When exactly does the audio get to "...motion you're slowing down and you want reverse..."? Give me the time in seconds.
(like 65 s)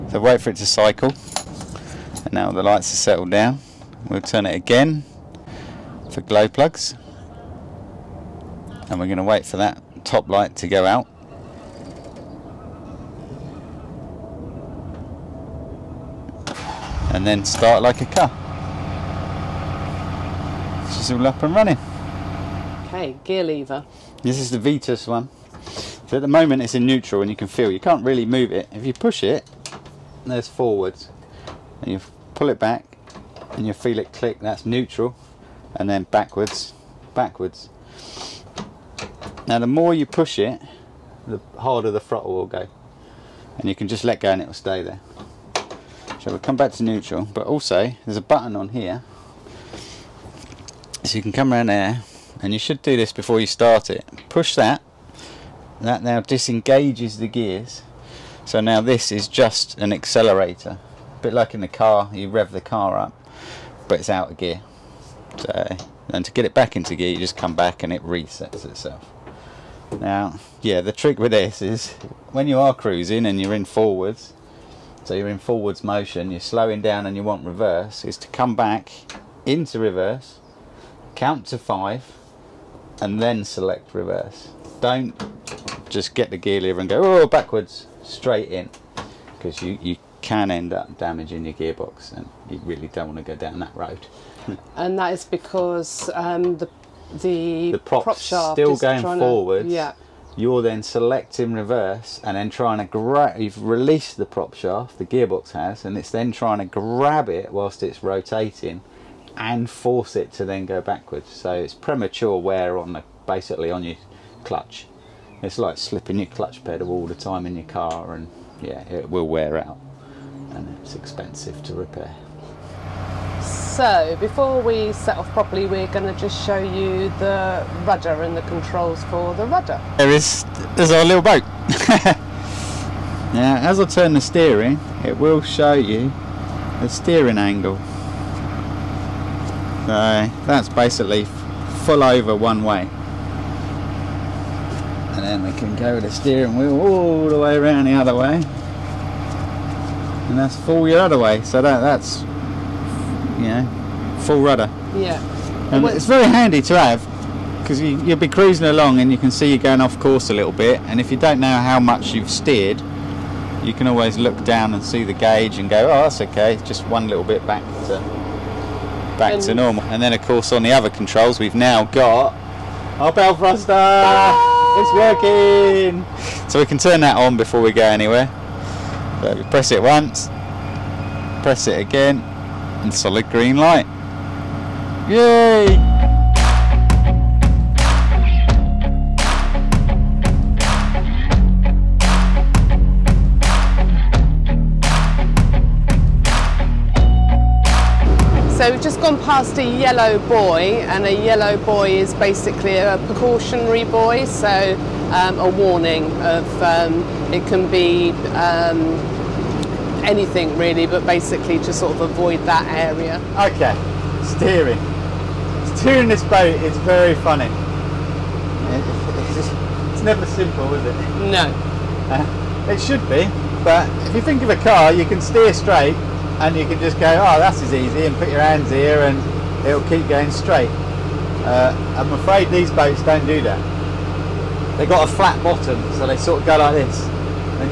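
75 s.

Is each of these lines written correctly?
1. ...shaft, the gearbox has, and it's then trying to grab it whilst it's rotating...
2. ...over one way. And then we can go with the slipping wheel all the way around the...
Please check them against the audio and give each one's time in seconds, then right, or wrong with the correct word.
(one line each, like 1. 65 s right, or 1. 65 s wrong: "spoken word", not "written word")
1. 104 s right
2. 142 s wrong: "steering", not "slipping".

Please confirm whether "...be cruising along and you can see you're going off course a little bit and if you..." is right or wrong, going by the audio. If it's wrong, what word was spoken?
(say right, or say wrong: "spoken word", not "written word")
right.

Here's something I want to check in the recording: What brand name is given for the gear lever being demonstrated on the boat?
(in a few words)
Vetus.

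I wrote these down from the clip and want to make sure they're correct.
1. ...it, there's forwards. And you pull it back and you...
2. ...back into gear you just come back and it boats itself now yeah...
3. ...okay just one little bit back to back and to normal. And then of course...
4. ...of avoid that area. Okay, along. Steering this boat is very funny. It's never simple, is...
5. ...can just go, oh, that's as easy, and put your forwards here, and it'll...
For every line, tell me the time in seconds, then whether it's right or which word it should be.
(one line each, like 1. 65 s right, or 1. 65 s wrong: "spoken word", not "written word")
1. 29 s right
2. 66 s wrong: "resets", not "boats"
3. 166 s right
4. 211 s wrong: "steering", not "along"
5. 226 s wrong: "hands", not "forwards".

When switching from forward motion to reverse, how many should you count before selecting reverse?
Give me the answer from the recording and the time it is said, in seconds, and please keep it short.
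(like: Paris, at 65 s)
5, at 81 s.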